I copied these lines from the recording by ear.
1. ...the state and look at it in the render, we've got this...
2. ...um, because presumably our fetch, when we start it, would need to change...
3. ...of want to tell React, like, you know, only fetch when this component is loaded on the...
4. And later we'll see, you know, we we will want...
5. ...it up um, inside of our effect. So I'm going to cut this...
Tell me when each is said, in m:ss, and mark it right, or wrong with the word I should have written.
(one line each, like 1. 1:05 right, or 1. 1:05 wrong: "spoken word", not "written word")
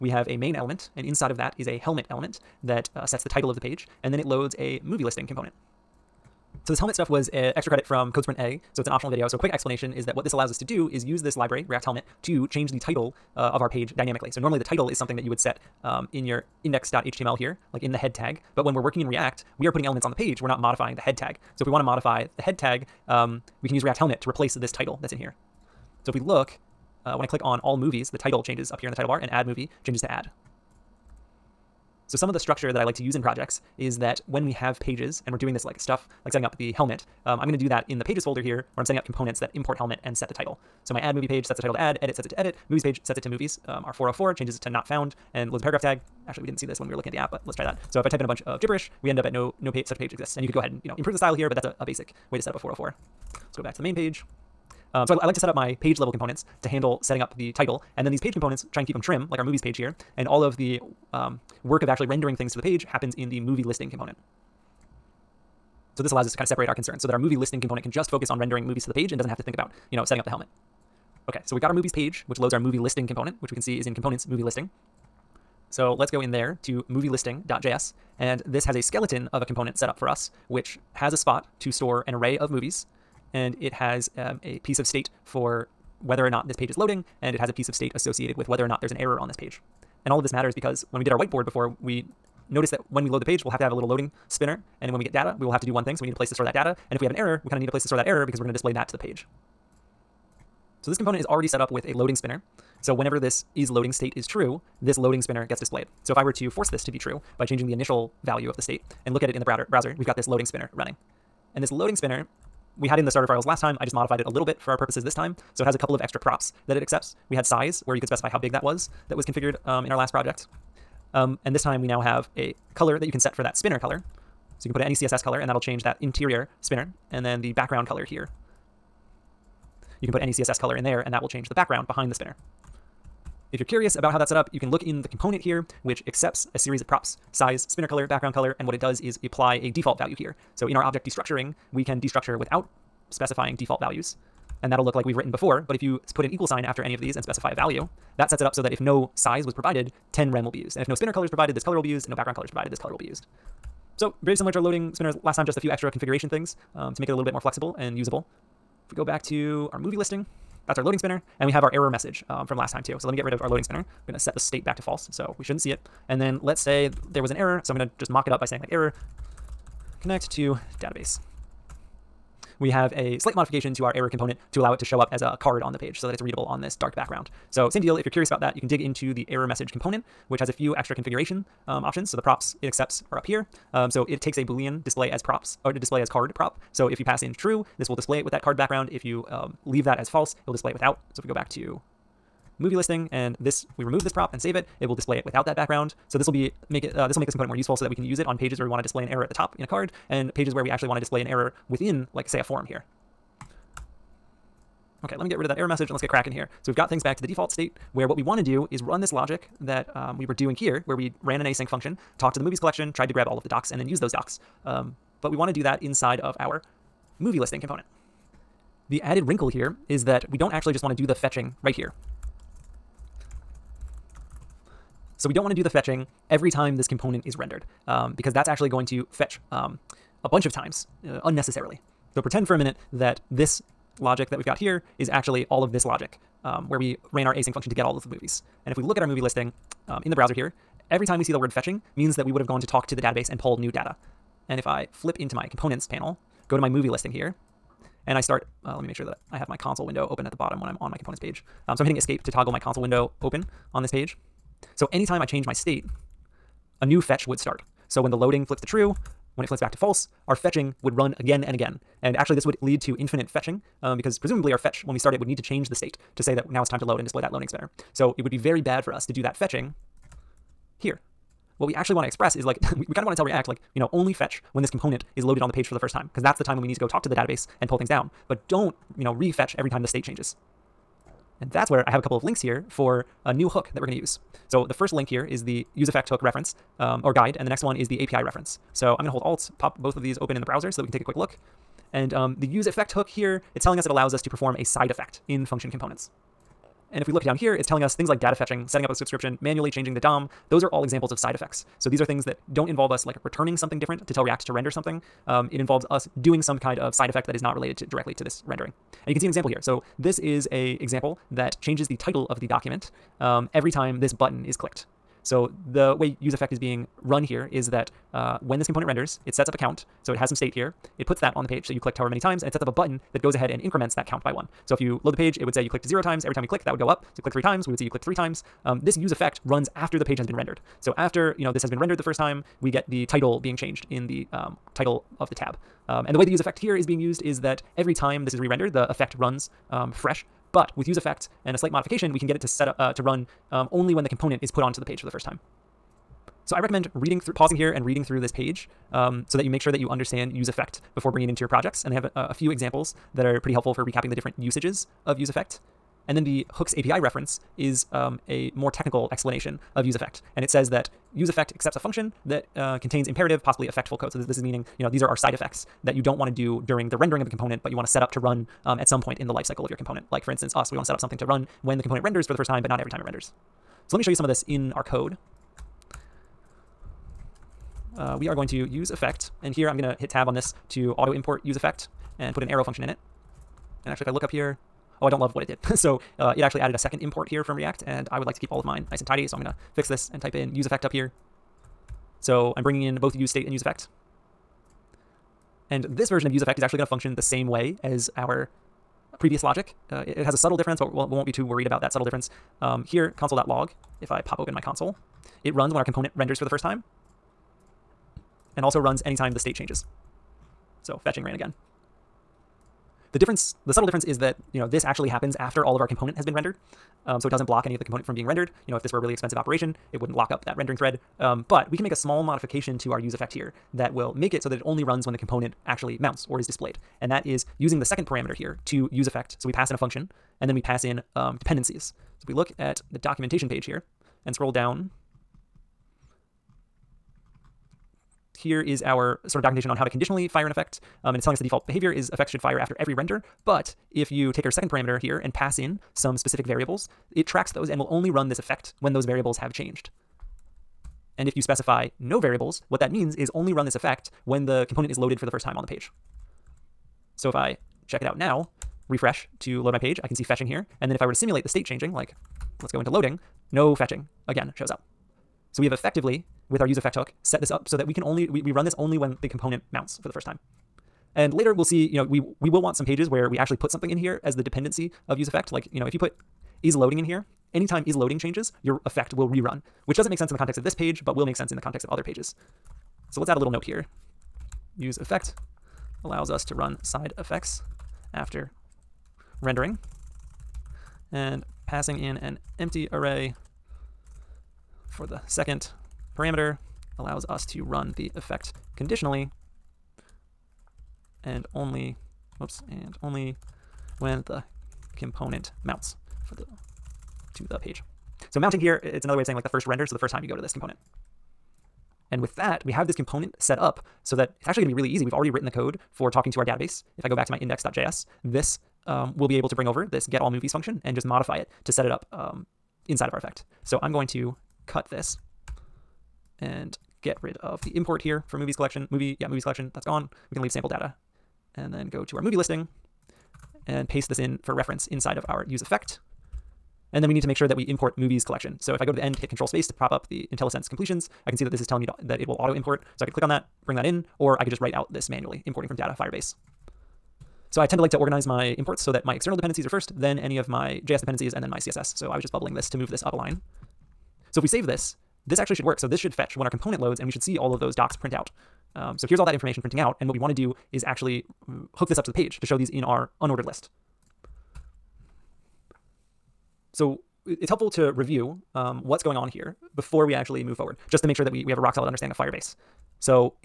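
1. 1:48 wrong: "browser", not "render"
2. 4:23 right
3. 4:33 right
4. 7:51 right
5. 8:41 right.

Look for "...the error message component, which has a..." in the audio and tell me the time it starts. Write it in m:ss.
2:59.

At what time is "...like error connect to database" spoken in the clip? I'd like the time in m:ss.
2:48.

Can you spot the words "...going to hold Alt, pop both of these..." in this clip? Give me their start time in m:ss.
4:49.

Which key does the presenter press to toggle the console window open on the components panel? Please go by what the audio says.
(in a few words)
escape.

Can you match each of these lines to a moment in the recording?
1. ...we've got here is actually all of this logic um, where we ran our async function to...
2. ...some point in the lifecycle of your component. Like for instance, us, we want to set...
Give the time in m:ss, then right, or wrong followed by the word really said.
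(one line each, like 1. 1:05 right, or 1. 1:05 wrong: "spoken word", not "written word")
1. 3:54 right
2. 6:08 right.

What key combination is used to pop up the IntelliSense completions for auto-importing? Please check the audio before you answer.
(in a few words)
control space.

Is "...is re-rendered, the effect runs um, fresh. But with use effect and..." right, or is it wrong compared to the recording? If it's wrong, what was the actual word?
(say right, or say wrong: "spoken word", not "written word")
right.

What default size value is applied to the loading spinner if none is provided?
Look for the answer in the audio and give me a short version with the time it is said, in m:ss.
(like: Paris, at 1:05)
10 rem, at 2:30.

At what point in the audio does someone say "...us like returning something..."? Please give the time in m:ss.
5:02.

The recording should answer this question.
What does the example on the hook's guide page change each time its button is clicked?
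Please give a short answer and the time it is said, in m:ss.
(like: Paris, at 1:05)
the title of the document, at 5:11.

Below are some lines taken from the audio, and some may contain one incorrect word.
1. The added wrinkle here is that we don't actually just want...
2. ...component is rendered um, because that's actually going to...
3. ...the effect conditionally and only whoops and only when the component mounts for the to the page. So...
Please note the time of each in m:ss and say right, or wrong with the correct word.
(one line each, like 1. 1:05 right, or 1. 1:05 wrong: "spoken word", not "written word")
1. 3:38 right
2. 3:46 right
3. 8:17 right.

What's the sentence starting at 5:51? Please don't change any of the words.
And they have a, a few examples that are pretty helpful for recapping the different usages of use effect.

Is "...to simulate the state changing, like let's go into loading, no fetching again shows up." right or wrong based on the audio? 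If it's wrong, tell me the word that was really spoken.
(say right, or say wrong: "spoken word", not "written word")
right.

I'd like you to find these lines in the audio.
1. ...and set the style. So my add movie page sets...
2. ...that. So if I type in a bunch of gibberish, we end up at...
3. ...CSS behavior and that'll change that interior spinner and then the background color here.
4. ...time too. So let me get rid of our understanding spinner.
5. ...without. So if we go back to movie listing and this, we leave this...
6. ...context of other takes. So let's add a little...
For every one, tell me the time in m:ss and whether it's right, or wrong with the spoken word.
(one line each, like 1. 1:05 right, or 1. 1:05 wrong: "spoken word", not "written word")
1. 0:40 wrong: "title", not "style"
2. 0:47 right
3. 2:04 wrong: "color", not "behavior"
4. 2:42 wrong: "loading", not "understanding"
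5. 3:10 wrong: "remove", not "leave"
6. 8:01 wrong: "pages", not "takes".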